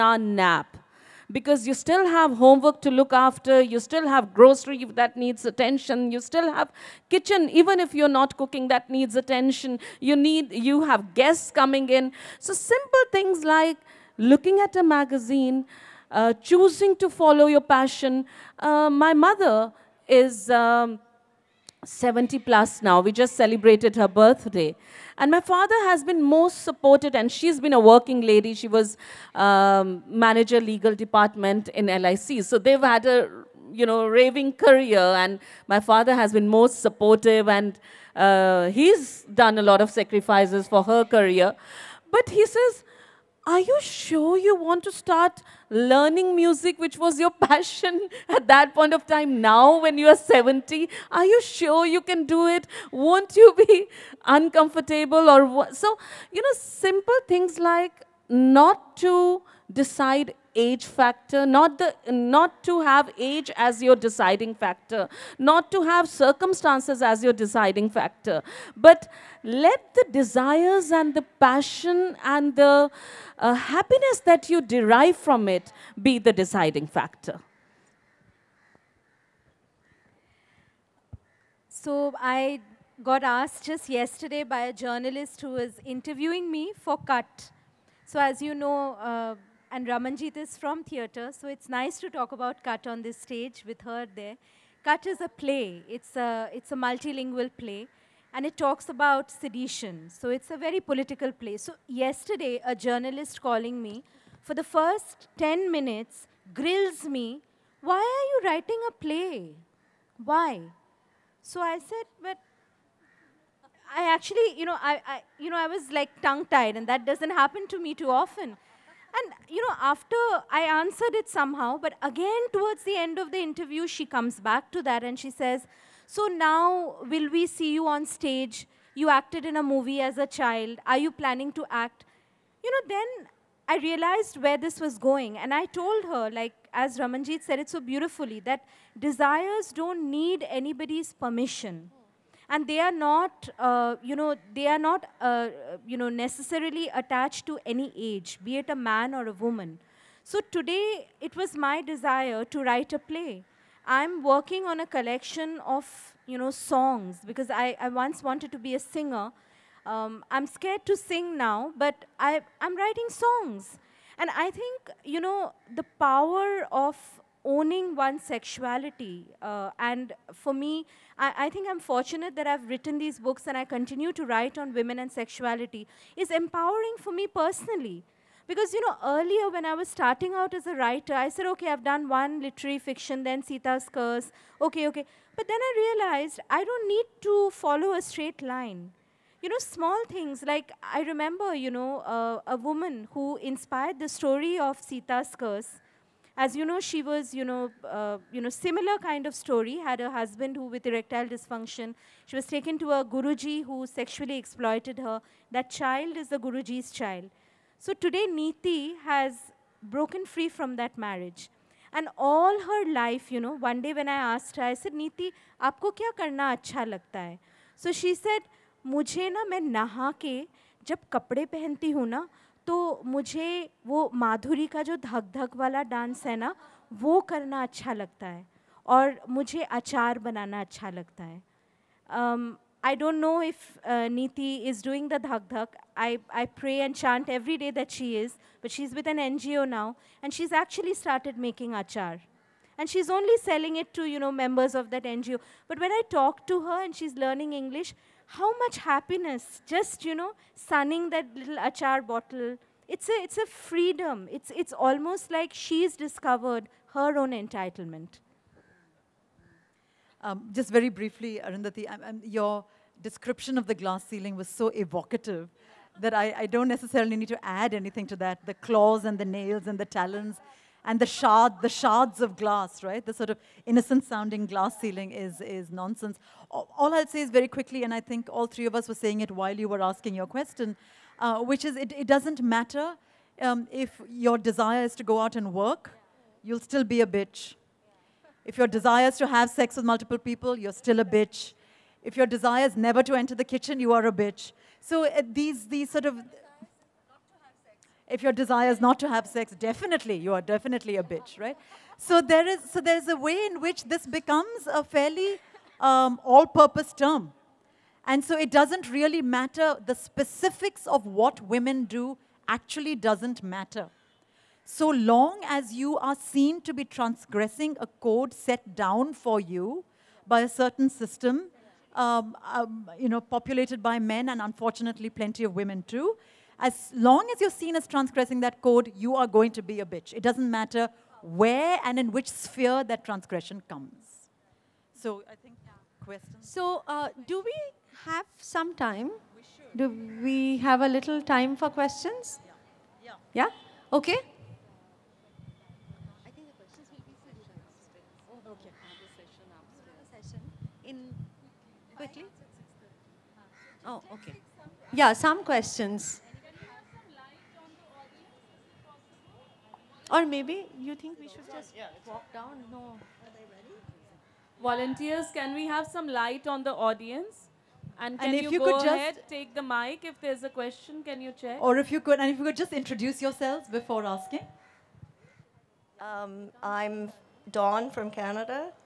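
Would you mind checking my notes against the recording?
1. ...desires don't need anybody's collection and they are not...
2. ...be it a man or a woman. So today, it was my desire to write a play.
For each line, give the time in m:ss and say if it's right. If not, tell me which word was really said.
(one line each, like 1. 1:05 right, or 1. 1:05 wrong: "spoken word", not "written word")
1. 2:18 wrong: "permission", not "collection"
2. 2:28 right.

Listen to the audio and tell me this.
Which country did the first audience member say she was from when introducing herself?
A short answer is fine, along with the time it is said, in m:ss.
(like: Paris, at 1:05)
Canada, at 6:18.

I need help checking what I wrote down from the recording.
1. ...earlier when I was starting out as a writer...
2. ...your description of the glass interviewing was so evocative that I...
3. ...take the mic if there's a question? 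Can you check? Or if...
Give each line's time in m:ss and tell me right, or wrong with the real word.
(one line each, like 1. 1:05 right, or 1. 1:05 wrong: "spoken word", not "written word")
1. 2:59 right
2. 4:22 wrong: "ceiling", not "interviewing"
3. 6:09 right.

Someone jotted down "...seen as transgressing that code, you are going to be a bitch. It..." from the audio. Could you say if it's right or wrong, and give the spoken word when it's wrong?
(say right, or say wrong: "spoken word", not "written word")
right.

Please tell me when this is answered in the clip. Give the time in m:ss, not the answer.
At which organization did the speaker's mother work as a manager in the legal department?
0:31.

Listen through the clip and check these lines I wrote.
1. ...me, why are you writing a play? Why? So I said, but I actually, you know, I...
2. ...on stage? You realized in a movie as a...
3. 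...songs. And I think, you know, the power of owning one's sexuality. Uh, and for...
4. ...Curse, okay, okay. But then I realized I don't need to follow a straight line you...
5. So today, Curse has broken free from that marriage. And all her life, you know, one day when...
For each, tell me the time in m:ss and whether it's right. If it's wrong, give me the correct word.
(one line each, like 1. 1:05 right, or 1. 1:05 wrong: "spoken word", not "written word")
1. 1:47 right
2. 2:07 wrong: "acted", not "realized"
3. 2:43 right
4. 3:03 right
5. 3:27 wrong: "Niti", not "Curse".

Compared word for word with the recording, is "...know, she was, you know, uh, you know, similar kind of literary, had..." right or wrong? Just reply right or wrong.
wrong.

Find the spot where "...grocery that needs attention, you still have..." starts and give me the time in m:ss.
0:04.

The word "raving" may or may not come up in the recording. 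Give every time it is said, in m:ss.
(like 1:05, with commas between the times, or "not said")
0:34.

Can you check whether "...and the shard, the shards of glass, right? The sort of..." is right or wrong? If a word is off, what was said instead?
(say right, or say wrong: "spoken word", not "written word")
right.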